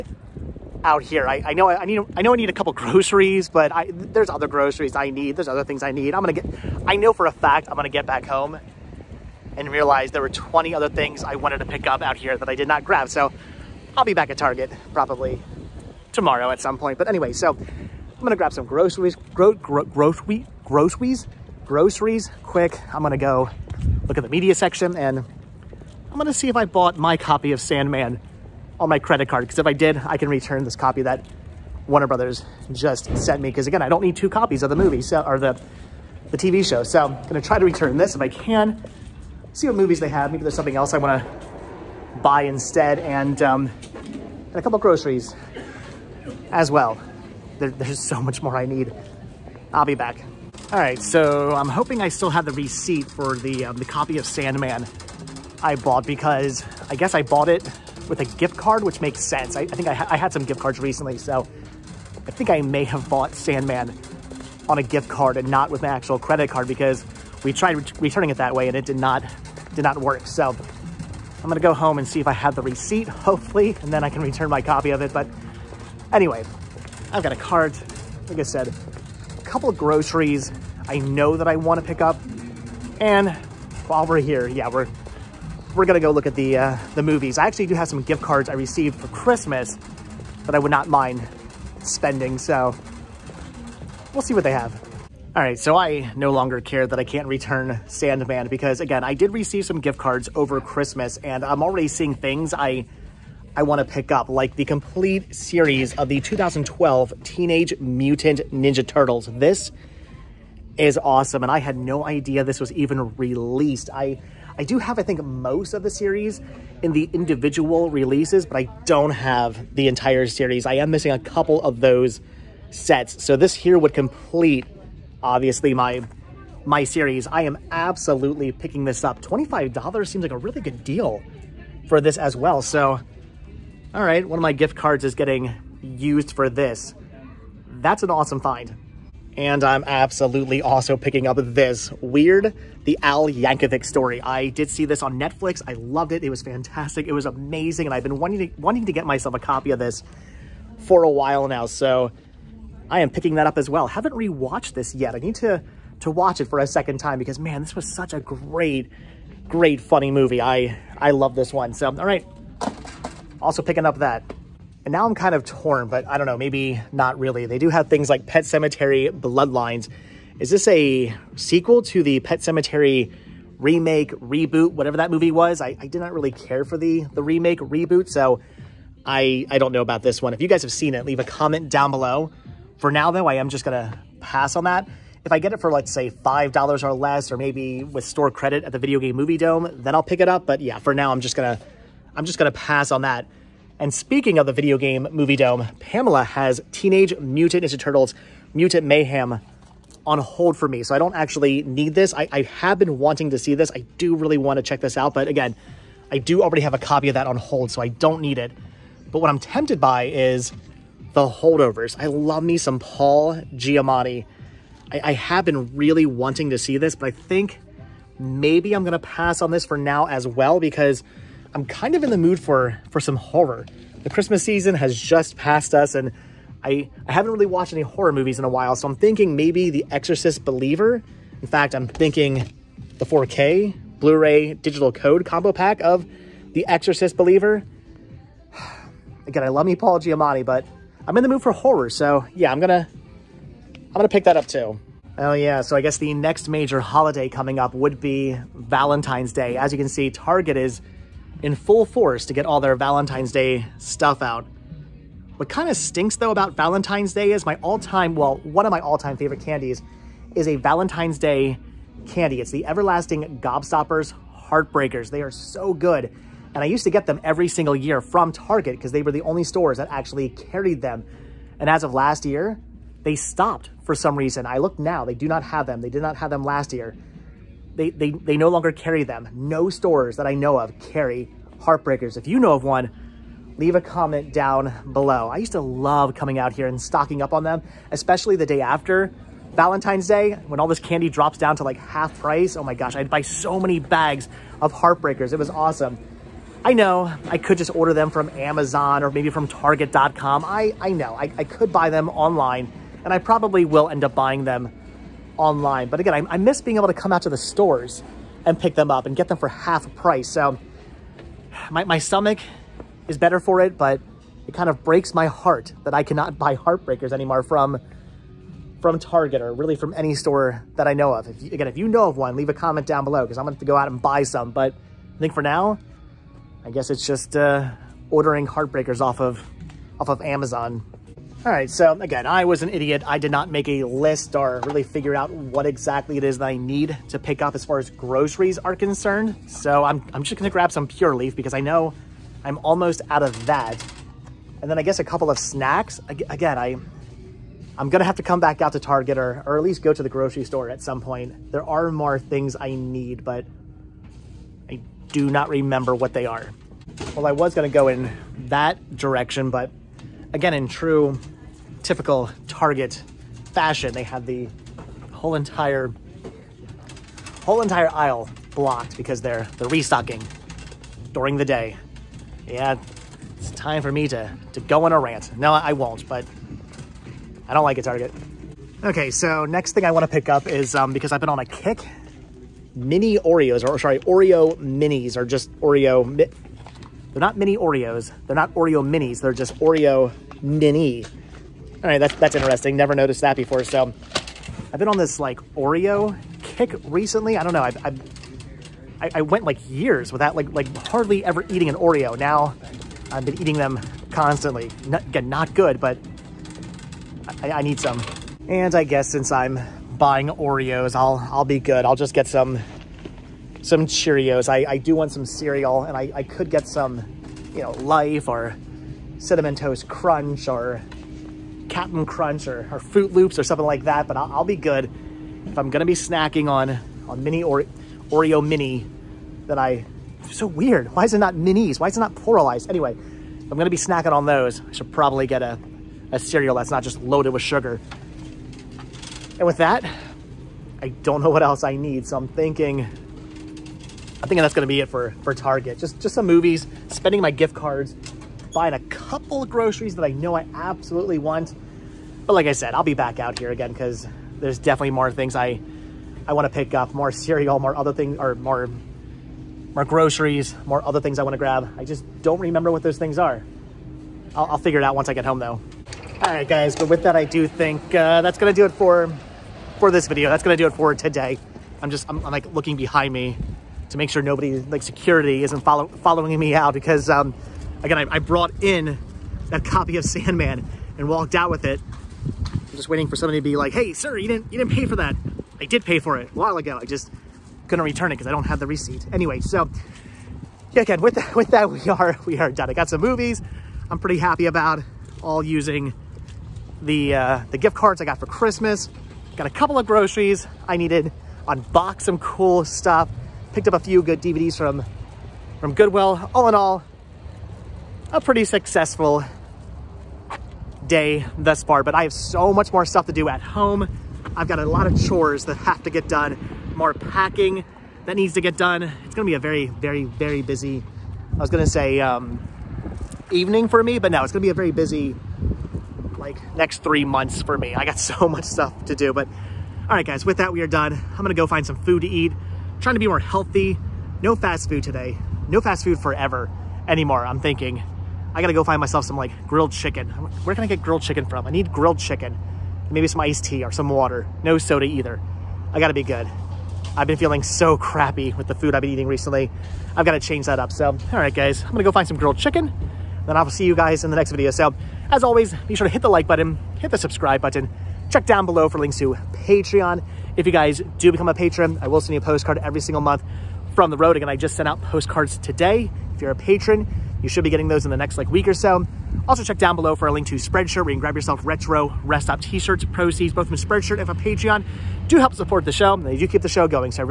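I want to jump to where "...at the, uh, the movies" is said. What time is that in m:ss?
1:26.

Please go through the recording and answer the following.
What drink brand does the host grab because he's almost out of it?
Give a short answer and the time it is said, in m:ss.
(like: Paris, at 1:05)
Pure Leaf, at 5:40.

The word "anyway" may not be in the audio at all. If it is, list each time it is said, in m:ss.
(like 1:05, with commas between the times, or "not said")
0:17, 1:16, 7:12, 8:09.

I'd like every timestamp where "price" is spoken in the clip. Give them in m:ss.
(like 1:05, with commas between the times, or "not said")
4:52, 5:09.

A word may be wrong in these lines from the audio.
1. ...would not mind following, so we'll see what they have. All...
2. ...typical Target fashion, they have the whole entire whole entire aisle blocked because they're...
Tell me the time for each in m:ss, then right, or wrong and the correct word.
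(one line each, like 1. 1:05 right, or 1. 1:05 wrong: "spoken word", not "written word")
1. 1:30 wrong: "spending", not "following"
2. 6:01 right.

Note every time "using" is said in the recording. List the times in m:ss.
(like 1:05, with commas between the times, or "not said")
8:15.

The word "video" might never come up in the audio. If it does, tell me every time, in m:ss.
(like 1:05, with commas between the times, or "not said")
3:08, 3:14, 7:50, 9:14.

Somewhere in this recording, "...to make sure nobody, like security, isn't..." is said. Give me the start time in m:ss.
7:53.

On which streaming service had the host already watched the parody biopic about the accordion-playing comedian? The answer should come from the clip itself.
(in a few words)
Netflix.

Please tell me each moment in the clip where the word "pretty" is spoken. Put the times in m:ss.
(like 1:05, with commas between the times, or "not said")
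8:13, 8:28.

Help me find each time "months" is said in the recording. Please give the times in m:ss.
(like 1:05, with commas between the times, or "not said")
8:47, 9:23.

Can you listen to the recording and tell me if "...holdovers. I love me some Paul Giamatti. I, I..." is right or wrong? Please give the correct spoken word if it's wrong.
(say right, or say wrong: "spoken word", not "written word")
right.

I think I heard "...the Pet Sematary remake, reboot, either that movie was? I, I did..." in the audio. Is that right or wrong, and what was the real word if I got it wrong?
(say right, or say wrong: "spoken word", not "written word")
wrong: "whatever", not "either".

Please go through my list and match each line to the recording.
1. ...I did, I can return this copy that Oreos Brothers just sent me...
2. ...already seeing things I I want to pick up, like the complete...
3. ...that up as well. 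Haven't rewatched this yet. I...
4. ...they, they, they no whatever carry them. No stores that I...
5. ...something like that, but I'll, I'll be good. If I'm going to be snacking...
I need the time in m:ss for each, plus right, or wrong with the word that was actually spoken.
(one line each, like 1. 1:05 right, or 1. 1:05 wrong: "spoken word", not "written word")
1. 0:29 wrong: "Warner", not "Oreos"
2. 1:41 right
3. 2:33 right
4. 4:37 wrong: "longer", not "whatever"
5. 7:03 right.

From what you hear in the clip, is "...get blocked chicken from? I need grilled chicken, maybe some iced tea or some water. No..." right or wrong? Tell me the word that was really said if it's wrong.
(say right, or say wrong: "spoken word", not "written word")
wrong: "grilled", not "blocked".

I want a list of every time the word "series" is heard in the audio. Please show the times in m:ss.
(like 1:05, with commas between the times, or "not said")
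1:45, 1:55, 2:00, 2:06.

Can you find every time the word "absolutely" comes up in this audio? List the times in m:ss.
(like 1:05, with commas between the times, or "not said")
2:07, 2:19, 7:30.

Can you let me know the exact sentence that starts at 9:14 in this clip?
So as always, be sure to hit the like button, hit the subscribe button, check down below for links to Patreon.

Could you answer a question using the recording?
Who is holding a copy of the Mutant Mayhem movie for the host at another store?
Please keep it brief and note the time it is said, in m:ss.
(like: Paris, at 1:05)
Pamela, at 3:15.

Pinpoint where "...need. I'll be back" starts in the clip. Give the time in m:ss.
0:48.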